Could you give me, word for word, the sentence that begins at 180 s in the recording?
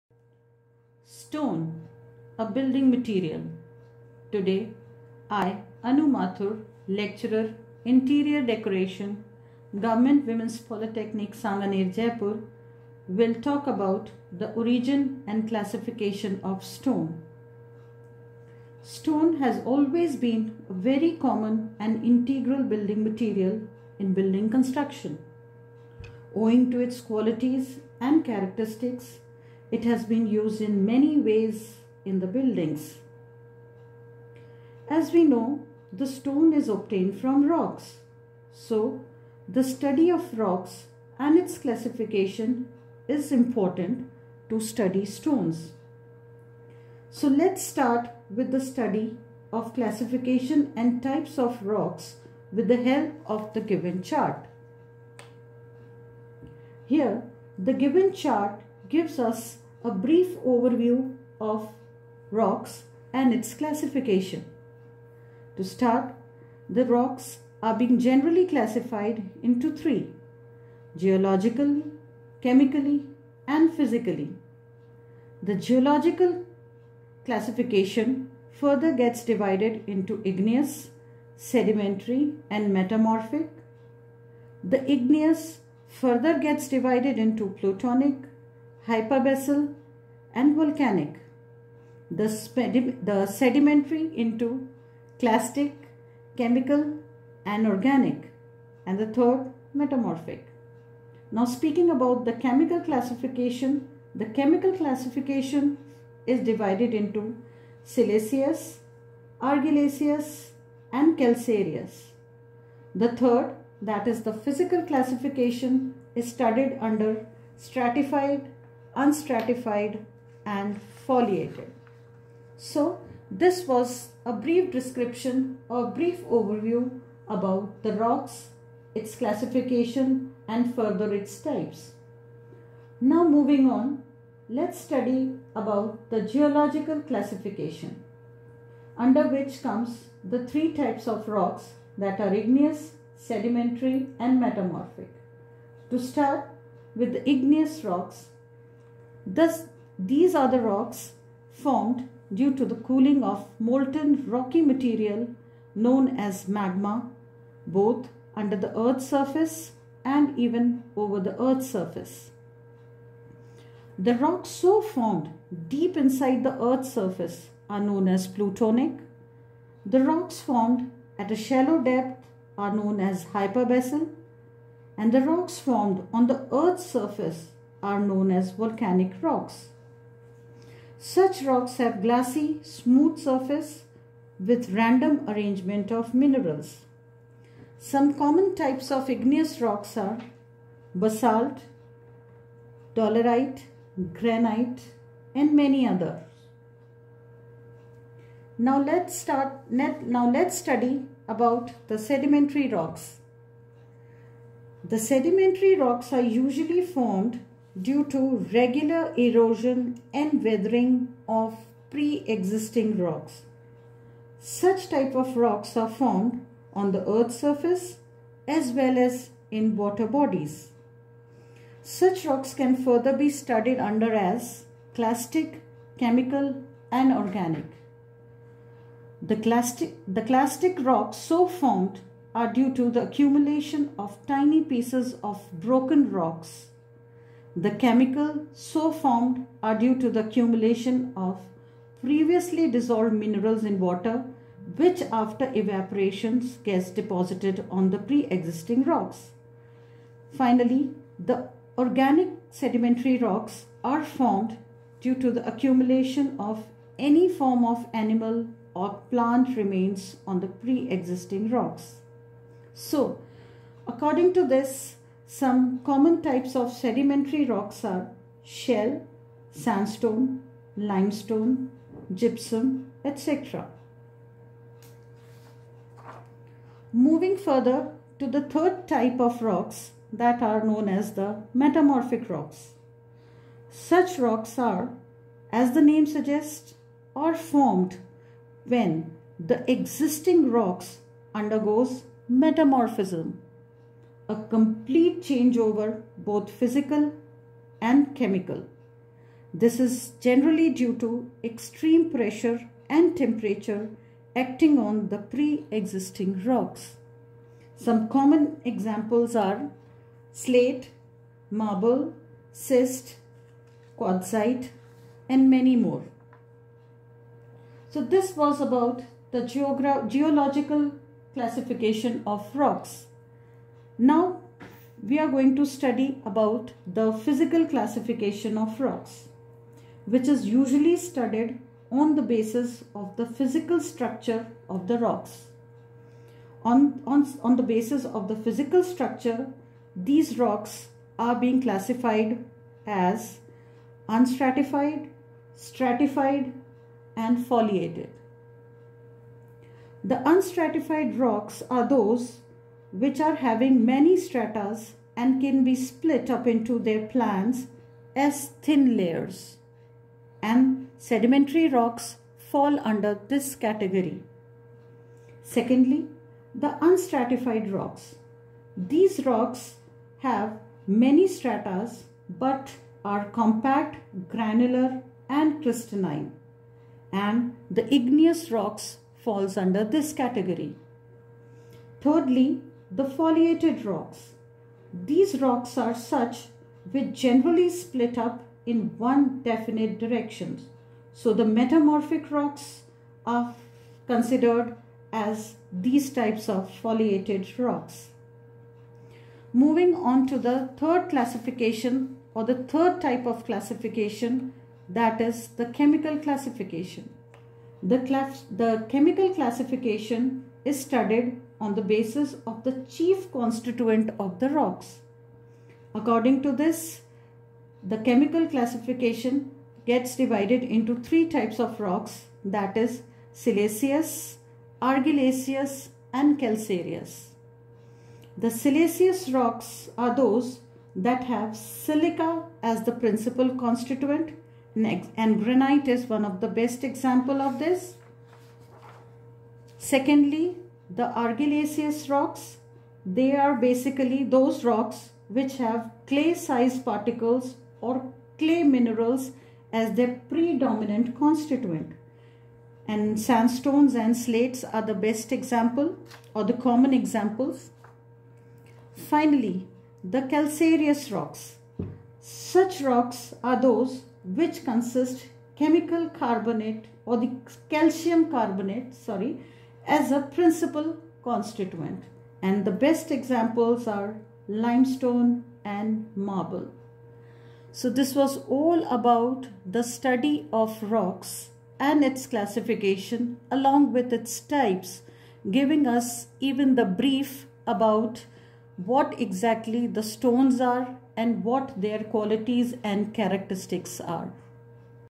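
Such rocks have glassy, smooth surface with random arrangement of minerals.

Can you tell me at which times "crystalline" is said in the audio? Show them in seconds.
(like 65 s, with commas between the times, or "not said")
375 s.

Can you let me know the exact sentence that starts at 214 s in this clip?
Such type of rocks are found on the earth's surface as well as in water bodies.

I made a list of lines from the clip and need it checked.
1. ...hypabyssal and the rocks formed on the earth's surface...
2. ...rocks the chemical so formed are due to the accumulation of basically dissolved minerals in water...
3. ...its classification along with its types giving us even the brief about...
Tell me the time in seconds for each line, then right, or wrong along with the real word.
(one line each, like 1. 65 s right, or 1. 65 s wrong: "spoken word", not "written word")
1. 173 s right
2. 236 s wrong: "previously", not "basically"
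3. 482 s right.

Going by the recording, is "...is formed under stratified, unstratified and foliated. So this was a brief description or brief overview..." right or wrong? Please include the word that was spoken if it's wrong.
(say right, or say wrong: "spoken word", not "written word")
wrong: "studied", not "formed".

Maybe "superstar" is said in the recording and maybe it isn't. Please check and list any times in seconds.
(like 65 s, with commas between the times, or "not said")
not said.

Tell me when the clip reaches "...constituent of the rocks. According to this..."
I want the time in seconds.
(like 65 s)
413 s.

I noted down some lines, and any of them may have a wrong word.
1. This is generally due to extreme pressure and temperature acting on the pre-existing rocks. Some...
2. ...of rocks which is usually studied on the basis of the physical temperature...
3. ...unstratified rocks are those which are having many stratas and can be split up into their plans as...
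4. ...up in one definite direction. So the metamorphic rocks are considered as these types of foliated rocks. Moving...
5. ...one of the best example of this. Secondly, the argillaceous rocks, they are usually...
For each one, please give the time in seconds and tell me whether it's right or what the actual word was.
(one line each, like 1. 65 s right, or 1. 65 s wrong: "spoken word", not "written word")
1. 299 s right
2. 328 s wrong: "structure", not "temperature"
3. 350 s right
4. 388 s right
5. 436 s wrong: "basically", not "usually".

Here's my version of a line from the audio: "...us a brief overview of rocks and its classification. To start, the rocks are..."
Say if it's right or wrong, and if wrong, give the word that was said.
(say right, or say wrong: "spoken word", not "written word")
right.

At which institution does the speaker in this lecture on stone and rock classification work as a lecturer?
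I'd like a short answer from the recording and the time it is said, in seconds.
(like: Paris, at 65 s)
Government Women's Polytechnic Sanganer, at 9 s.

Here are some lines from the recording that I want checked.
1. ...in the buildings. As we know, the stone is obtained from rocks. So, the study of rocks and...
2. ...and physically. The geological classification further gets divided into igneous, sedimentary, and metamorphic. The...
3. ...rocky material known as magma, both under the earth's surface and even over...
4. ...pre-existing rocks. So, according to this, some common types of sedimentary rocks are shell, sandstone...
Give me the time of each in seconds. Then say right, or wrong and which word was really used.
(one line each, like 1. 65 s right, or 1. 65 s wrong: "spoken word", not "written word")
1. 32 s right
2. 73 s right
3. 154 s right
4. 260 s right.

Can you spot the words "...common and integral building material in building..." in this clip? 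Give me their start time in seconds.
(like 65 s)
21 s.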